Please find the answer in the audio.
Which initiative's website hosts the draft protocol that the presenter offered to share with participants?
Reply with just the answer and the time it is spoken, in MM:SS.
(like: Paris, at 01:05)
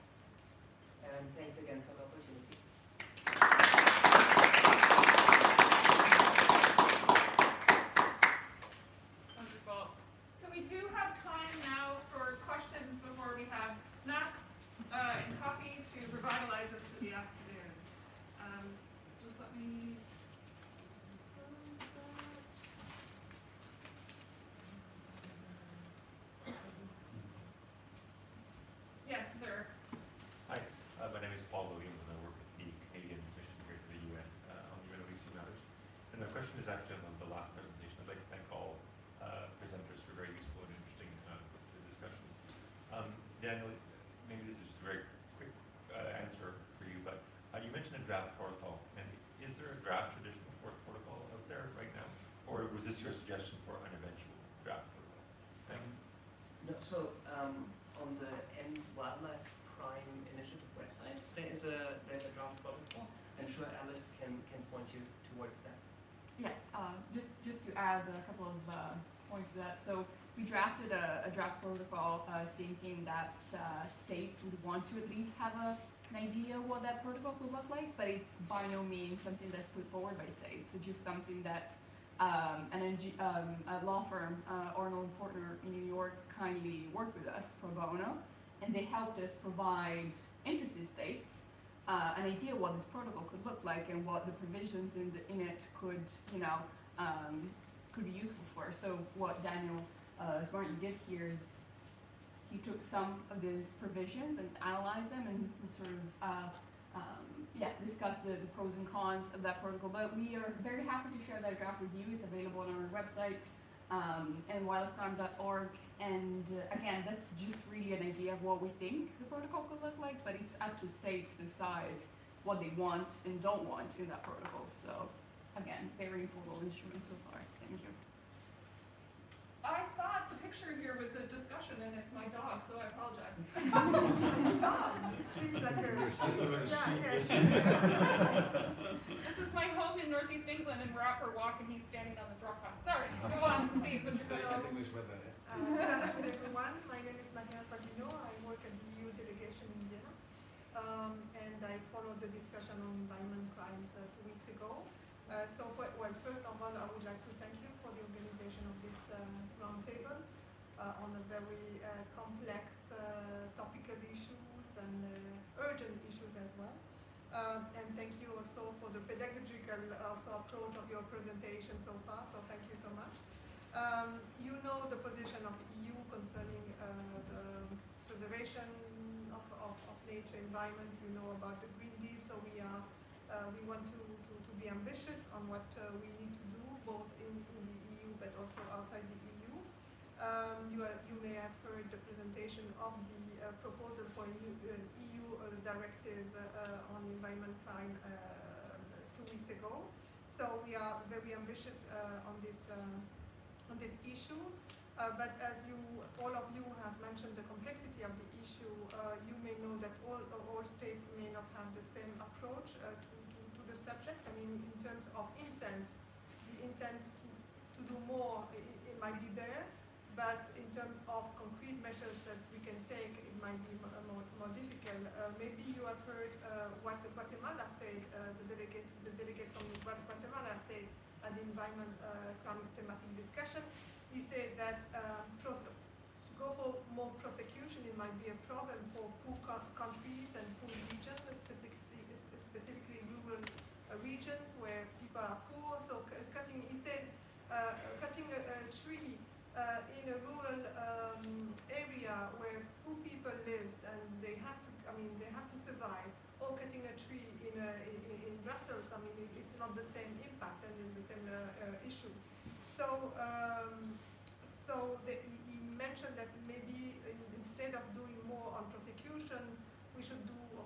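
End Wildlife Crime Initiative, at 00:58.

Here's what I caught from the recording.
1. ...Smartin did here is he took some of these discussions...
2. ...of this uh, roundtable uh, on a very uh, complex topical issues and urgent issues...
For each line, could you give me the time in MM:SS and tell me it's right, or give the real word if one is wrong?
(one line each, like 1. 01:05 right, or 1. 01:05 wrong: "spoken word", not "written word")
1. 01:40 wrong: "provisions", not "discussions"
2. 02:38 right.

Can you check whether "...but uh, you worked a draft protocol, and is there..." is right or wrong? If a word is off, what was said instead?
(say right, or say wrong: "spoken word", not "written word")
wrong: "mentioned", not "worked".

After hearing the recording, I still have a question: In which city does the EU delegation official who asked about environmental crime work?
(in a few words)
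Vienna.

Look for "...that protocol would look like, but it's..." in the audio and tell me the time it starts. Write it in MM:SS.
01:16.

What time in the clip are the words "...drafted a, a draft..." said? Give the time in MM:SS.
01:10.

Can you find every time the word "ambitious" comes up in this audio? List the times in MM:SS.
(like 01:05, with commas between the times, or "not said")
03:04, 03:21.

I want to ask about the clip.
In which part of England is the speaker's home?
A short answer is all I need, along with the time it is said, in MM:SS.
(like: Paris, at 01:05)
Northeast England, at 02:20.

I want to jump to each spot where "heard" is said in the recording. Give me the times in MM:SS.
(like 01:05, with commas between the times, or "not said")
03:11, 03:46.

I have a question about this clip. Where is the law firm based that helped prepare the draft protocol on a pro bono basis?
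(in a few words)
New York.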